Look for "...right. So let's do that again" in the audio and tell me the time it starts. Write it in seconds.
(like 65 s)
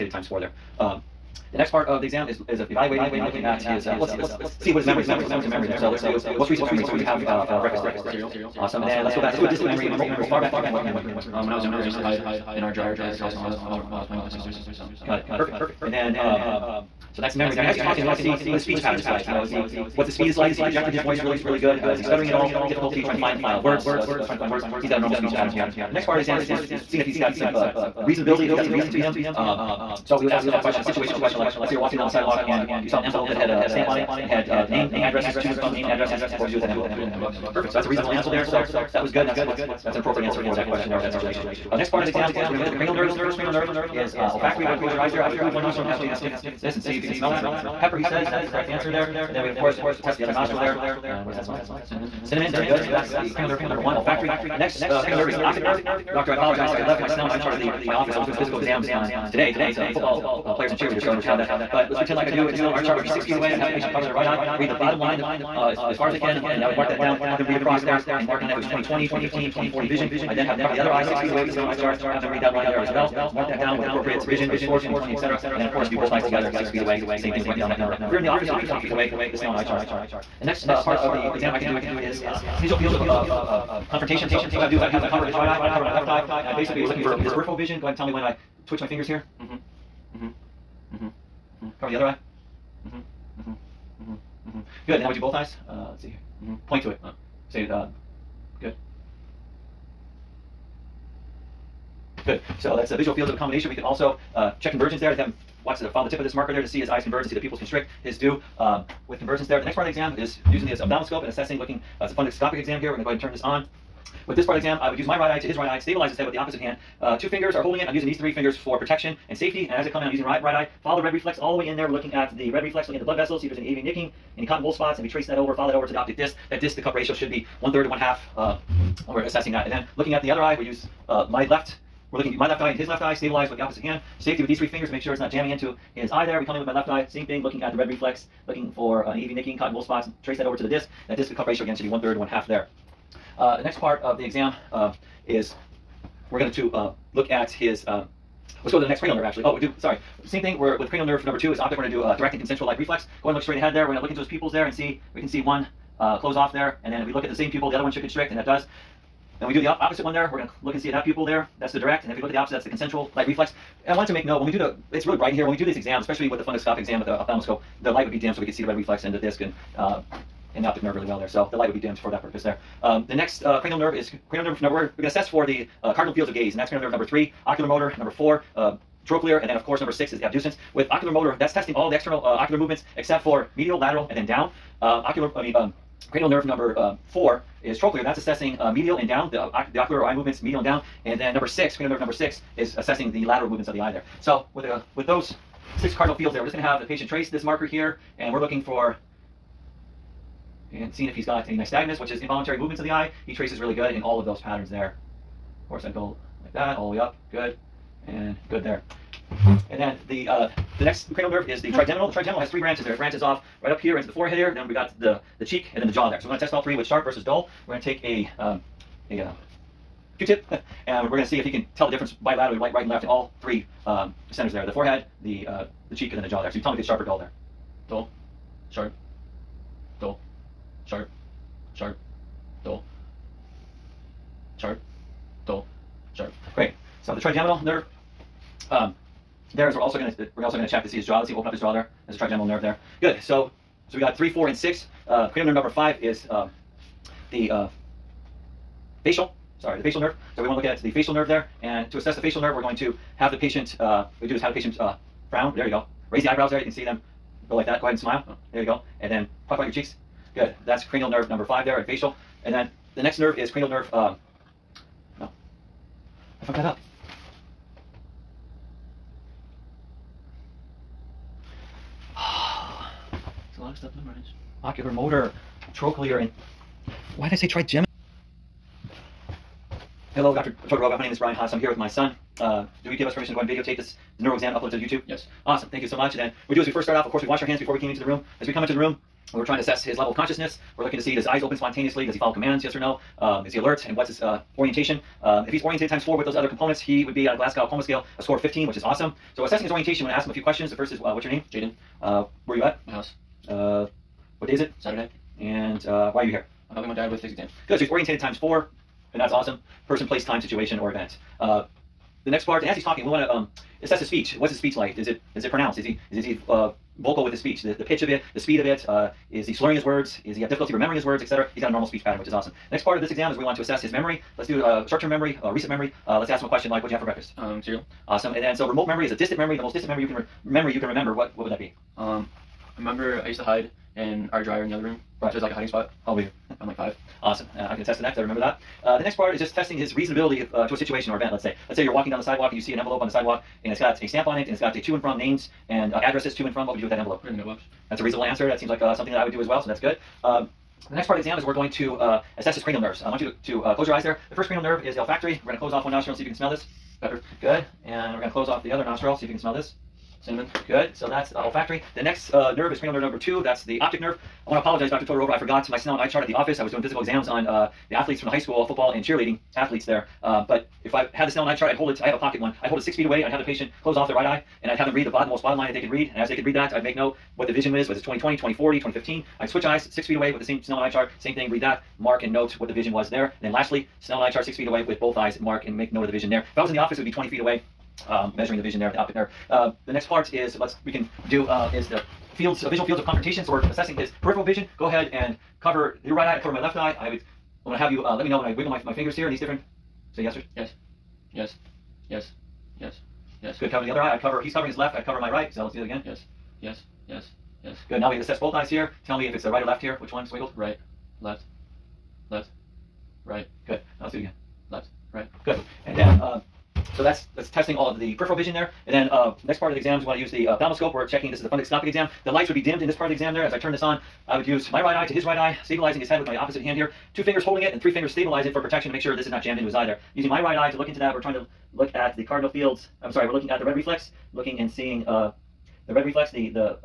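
405 s.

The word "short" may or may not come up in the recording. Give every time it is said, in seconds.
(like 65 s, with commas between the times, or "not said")
324 s.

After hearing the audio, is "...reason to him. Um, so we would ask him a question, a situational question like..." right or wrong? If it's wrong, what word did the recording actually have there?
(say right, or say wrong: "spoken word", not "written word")
right.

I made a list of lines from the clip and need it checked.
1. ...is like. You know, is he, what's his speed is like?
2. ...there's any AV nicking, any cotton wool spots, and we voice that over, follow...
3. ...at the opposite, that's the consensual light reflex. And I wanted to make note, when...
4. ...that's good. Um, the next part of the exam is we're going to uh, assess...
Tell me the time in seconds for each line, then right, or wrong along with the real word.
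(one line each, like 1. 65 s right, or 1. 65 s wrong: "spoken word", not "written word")
1. 18 s right
2. 123 s wrong: "trace", not "voice"
3. 162 s right
4. 349 s right.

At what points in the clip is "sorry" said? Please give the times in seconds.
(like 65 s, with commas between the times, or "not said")
149 s, 249 s, 433 s.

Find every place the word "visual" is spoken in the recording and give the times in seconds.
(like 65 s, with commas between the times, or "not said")
82 s, 102 s, 392 s.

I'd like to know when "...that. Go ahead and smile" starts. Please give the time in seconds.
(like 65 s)
257 s.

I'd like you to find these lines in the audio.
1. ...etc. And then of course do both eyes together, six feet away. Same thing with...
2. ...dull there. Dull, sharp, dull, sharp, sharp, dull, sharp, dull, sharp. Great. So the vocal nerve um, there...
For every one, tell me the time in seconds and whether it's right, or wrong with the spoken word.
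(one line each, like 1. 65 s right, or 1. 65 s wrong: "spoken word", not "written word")
1. 75 s right
2. 227 s wrong: "trigeminal", not "vocal".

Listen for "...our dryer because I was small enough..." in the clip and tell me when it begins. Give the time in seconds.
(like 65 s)
12 s.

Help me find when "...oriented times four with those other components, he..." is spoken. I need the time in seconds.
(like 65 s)
295 s.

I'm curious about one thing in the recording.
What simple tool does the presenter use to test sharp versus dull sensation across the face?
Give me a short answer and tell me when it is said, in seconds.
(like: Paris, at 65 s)
Q-tip, at 220 s.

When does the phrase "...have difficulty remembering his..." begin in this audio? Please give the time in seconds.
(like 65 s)
320 s.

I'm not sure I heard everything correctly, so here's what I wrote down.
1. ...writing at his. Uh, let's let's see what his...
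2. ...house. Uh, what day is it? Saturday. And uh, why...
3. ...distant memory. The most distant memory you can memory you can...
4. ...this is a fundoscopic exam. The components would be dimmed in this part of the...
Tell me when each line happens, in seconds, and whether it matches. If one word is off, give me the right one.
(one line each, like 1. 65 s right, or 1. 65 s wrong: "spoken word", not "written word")
1. 3 s wrong: "looking", not "writing"
2. 302 s right
3. 329 s right
4. 421 s wrong: "lights", not "components".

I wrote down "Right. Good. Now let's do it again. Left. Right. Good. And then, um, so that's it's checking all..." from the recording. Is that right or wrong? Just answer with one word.
wrong.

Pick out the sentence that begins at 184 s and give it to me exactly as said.
Um, ocular, I mean, um, cranial nerve number uh, four is trochlear.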